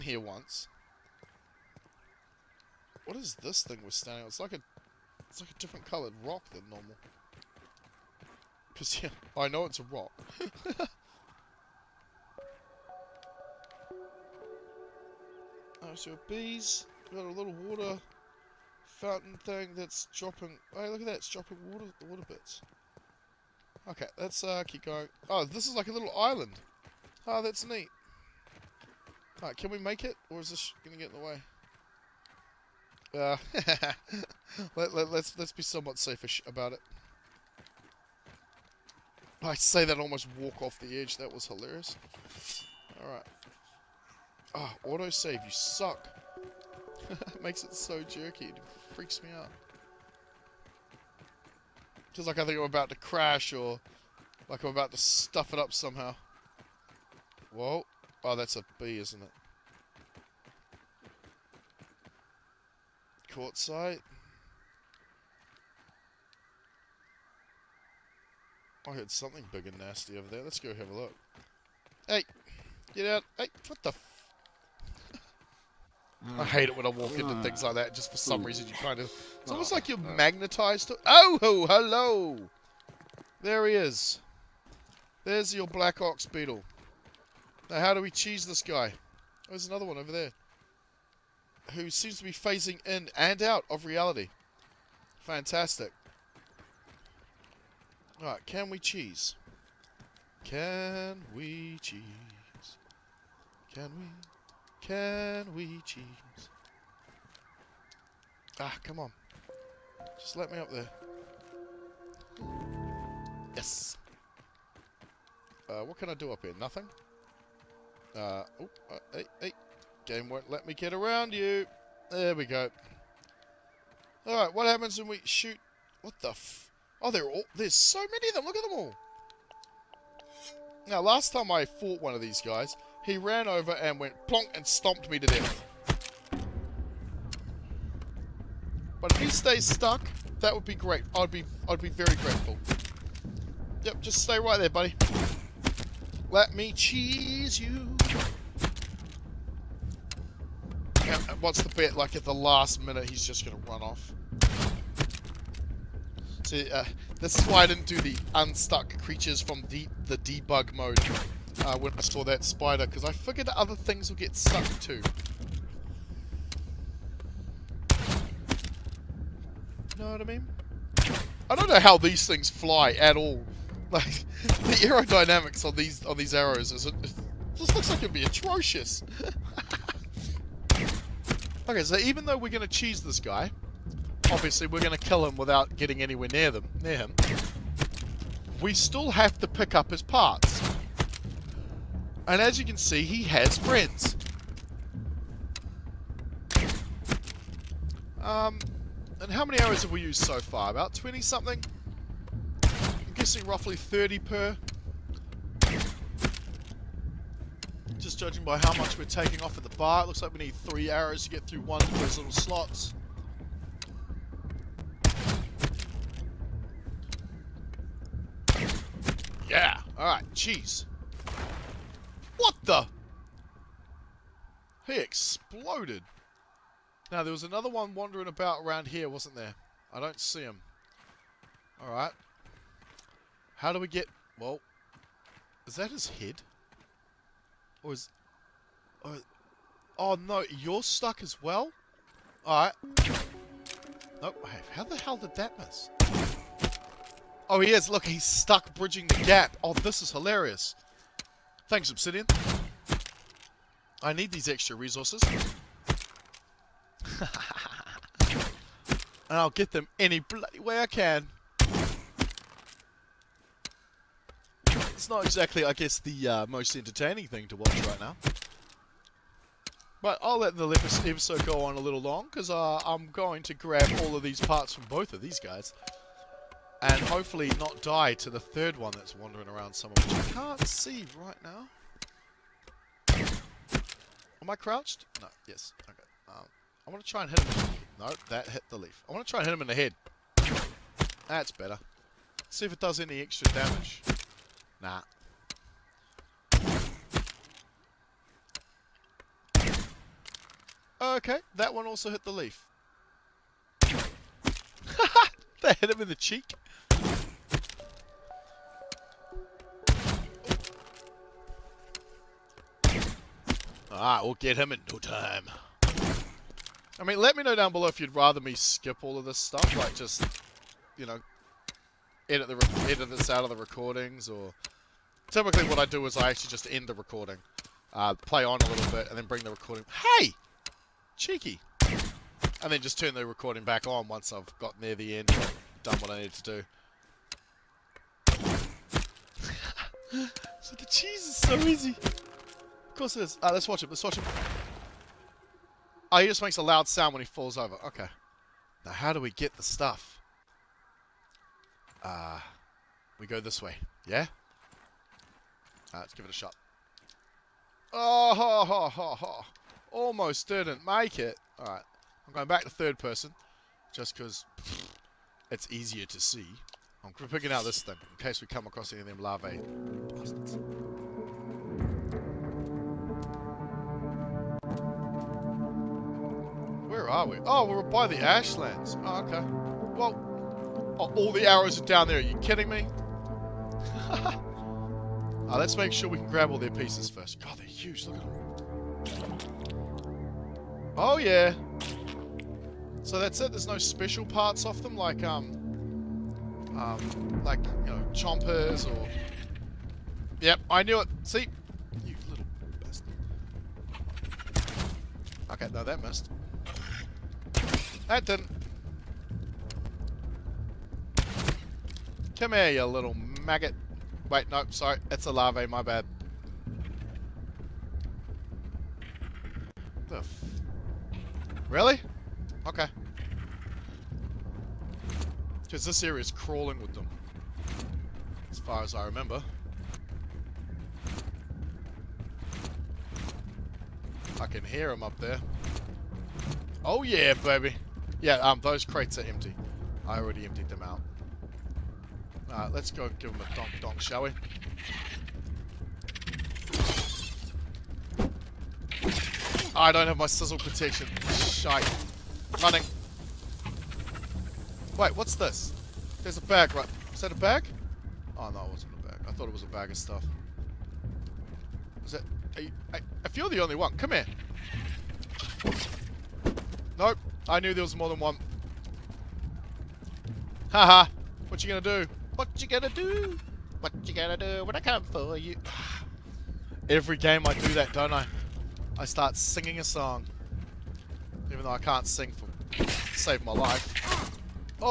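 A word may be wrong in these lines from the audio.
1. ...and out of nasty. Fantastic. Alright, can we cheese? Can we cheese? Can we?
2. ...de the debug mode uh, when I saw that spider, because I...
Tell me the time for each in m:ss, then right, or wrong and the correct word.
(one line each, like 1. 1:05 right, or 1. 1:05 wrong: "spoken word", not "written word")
1. 1:33 wrong: "reality", not "nasty"
2. 2:39 right.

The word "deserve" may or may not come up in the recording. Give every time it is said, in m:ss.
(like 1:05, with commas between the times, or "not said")
not said.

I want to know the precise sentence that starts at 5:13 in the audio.
Alright, we'll get him in no time.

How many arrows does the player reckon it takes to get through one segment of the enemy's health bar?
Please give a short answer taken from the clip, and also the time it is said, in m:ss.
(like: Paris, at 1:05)
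3, at 3:30.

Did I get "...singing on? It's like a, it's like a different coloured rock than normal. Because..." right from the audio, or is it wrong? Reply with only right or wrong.
wrong.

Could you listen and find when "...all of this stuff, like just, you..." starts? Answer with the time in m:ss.
5:19.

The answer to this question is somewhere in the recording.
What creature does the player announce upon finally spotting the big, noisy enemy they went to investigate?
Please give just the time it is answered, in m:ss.
1:25.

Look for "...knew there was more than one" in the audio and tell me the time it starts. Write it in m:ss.
7:47.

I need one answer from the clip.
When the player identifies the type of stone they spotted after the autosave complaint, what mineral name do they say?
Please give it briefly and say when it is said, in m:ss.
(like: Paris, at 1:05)
Quartzite, at 1:03.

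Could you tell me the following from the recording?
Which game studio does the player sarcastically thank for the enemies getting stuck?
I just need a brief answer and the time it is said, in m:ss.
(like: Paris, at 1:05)
Obsidian, at 4:11.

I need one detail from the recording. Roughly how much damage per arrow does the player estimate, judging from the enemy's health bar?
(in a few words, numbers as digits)
30.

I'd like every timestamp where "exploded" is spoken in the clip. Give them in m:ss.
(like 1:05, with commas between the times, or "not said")
3:44.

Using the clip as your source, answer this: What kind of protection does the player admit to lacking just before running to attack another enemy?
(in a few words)
Sizzle protection.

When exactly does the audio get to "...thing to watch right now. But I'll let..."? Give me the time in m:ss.
4:27.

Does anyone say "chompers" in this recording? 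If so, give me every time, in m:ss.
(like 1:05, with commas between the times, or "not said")
6:38.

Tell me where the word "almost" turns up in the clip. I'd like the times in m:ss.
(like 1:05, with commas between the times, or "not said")
0:39, 1:19, 5:59.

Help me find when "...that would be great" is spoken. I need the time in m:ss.
2:20.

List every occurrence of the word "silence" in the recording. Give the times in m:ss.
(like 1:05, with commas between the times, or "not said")
not said.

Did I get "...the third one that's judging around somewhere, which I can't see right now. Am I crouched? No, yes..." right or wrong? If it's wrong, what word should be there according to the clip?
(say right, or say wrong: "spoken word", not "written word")
wrong: "wandering", not "judging".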